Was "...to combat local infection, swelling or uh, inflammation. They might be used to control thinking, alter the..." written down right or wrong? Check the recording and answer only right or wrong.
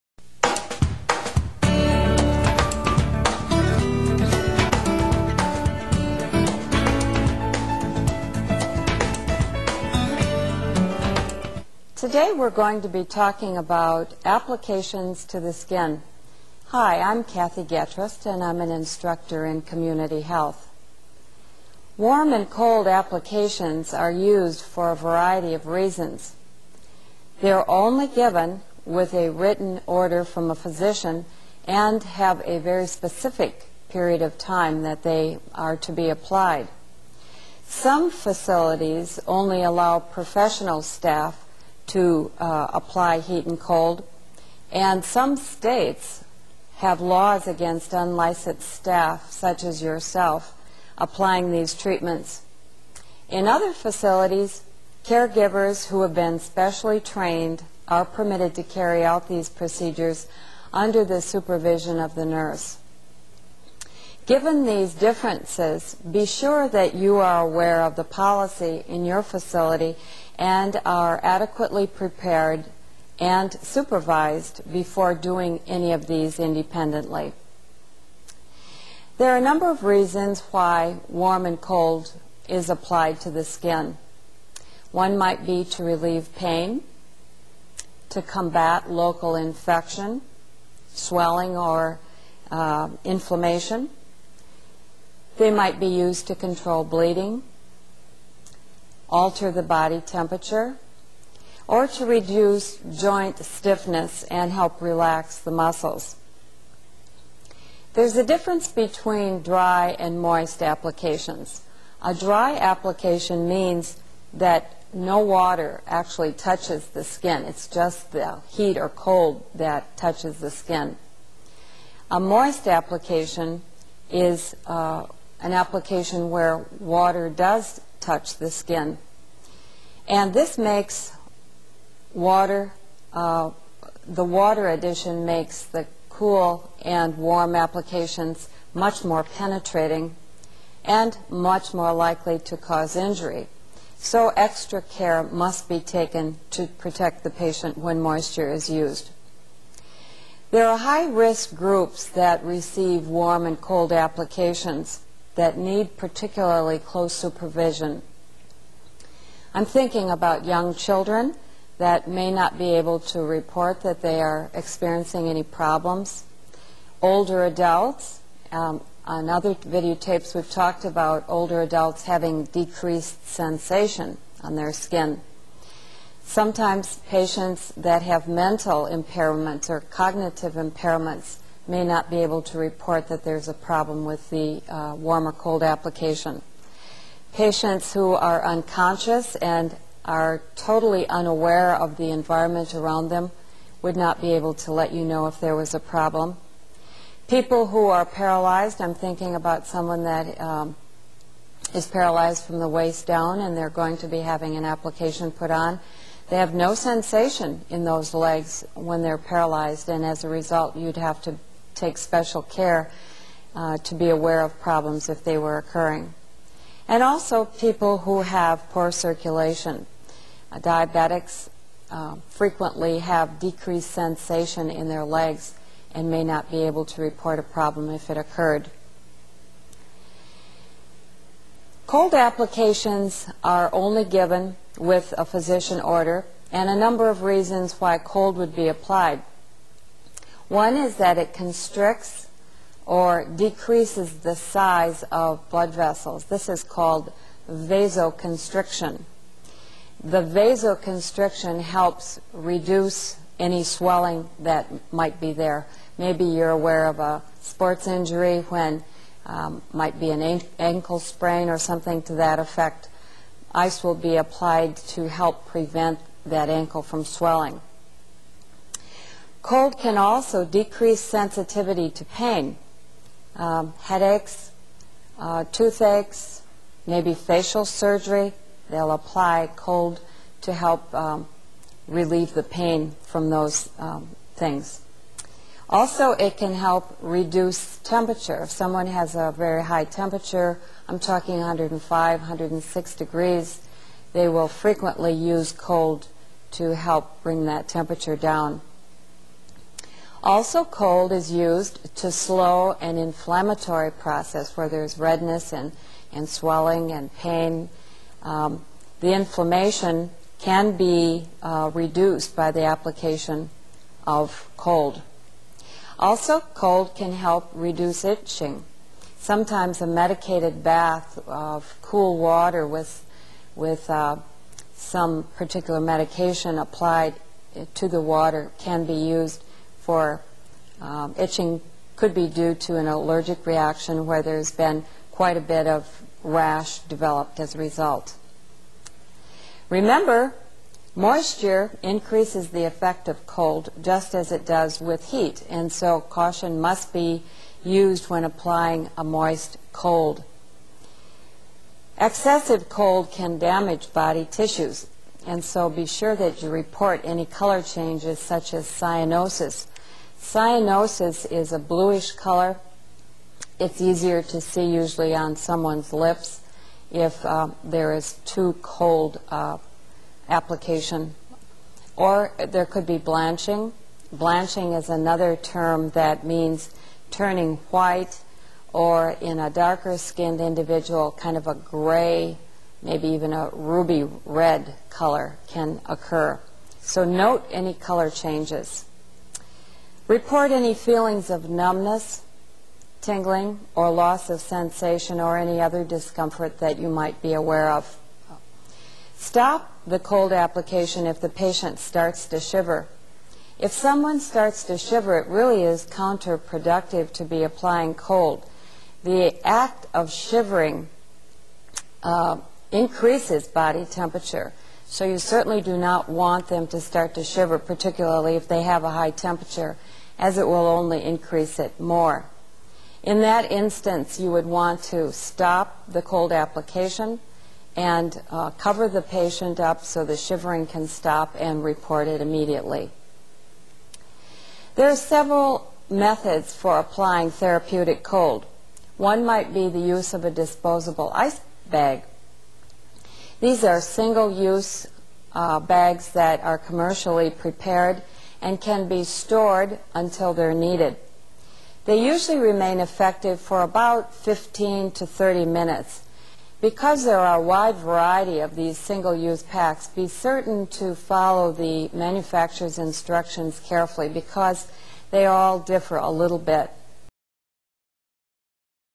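wrong.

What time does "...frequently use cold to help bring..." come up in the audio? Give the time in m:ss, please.
4:54.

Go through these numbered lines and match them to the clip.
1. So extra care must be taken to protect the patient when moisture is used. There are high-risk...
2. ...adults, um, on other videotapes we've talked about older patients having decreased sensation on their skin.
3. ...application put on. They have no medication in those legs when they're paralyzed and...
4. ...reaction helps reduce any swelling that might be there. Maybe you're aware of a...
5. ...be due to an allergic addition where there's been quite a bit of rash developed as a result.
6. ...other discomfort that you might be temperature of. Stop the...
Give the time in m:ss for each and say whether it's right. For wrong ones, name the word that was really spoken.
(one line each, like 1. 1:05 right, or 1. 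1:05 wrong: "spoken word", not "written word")
1. 2:23 right
2. 2:47 wrong: "adults", not "patients"
3. 3:24 wrong: "sensation", not "medication"
4. 4:10 wrong: "vasoconstriction", not "reaction"
5. 5:32 wrong: "reaction", not "addition"
6. 6:35 wrong: "aware", not "temperature".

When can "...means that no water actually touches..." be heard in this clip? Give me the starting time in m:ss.
1:53.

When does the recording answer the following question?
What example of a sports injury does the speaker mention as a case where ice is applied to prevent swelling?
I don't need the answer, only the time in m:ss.
4:20.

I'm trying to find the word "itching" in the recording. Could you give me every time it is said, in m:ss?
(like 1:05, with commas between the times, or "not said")
5:18, 5:31.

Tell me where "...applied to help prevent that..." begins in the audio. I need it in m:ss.
4:24.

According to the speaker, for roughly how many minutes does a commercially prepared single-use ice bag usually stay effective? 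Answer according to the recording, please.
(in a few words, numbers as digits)
15 to 30 minutes.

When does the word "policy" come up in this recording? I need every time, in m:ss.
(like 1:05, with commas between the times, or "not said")
1:08.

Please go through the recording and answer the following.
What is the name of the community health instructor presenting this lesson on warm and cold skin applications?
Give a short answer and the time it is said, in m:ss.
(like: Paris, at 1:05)
Kathy Getrist, at 0:17.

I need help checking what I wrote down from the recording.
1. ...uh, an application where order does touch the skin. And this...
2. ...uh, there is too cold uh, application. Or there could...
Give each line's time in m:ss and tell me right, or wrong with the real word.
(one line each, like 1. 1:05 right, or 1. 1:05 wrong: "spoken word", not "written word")
1. 2:04 wrong: "water", not "order"
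2. 6:07 right.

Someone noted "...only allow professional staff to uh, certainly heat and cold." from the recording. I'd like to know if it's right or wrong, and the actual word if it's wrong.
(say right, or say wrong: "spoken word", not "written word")
wrong: "apply", not "certainly".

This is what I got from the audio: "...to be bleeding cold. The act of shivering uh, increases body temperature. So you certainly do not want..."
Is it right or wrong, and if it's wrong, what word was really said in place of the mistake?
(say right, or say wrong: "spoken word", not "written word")
wrong: "applying", not "bleeding".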